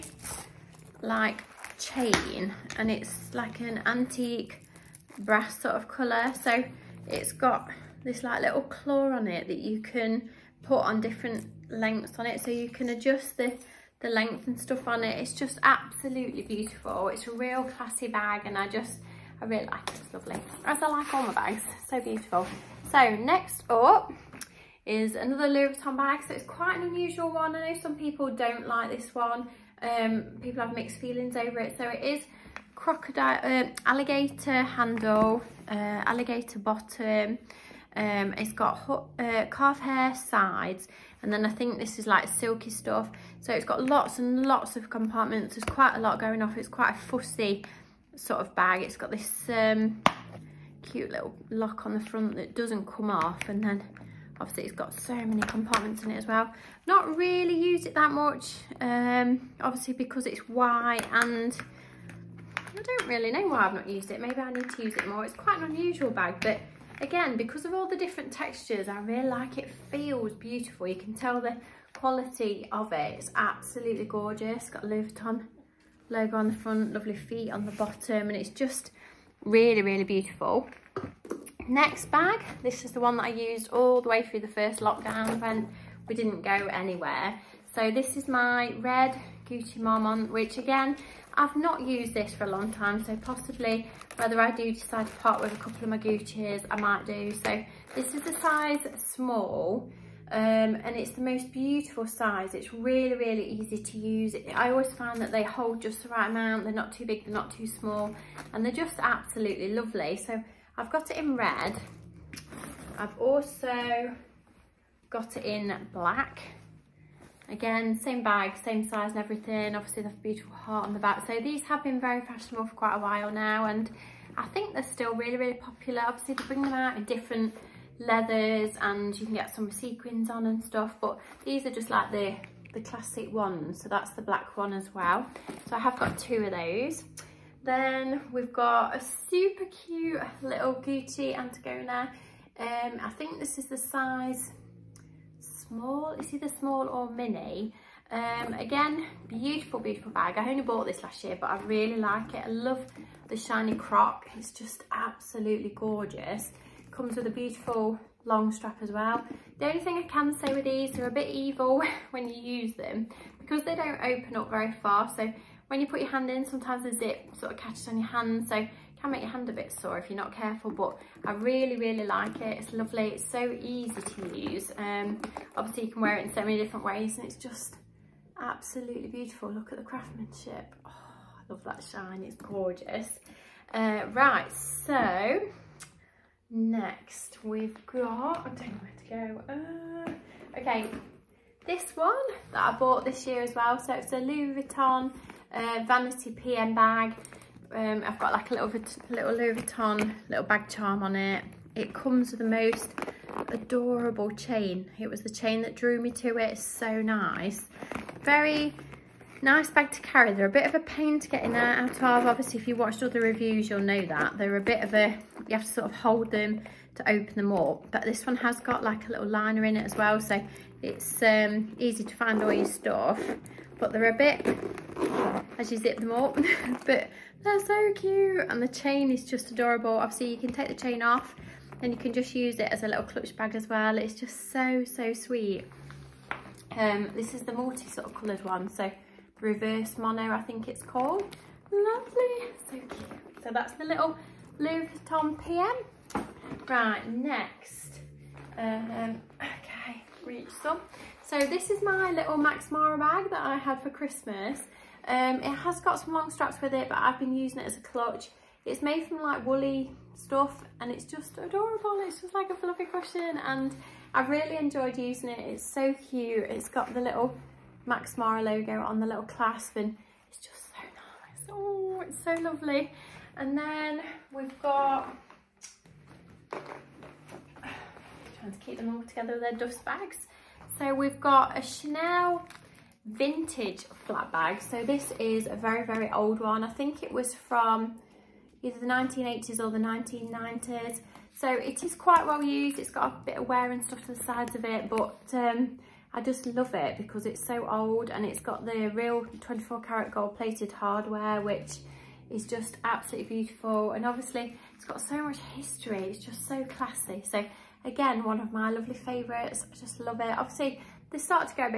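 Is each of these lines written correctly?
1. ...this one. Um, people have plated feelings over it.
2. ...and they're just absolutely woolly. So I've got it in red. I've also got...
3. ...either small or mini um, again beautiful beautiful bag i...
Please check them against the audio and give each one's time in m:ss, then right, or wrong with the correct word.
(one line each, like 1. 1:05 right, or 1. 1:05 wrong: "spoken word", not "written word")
1. 0:28 wrong: "mixed", not "plated"
2. 1:48 wrong: "lovely", not "woolly"
3. 2:26 right.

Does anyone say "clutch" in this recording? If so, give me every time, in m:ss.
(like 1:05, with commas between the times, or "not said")
3:53, 4:17.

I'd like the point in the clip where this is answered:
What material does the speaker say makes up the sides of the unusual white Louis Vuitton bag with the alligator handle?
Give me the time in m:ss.
0:39.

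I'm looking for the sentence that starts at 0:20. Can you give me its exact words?
As I like all my bags, so beautiful.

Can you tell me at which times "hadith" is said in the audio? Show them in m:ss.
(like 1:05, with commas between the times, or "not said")
not said.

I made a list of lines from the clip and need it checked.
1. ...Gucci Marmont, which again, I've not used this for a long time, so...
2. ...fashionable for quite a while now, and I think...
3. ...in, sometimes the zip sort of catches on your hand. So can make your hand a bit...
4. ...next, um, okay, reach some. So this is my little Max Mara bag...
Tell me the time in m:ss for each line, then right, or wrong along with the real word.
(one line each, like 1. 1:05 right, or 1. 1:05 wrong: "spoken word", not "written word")
1. 1:29 right
2. 2:02 right
3. 2:46 right
4. 4:07 right.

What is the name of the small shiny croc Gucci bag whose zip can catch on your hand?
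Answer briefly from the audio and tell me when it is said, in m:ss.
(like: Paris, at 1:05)
Antigona, at 2:21.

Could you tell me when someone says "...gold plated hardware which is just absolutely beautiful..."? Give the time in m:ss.
5:00.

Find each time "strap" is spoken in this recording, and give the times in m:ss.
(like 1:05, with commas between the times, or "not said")
2:38, 4:16.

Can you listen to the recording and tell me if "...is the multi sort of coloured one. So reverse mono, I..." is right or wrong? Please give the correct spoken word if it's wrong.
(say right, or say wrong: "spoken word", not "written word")
right.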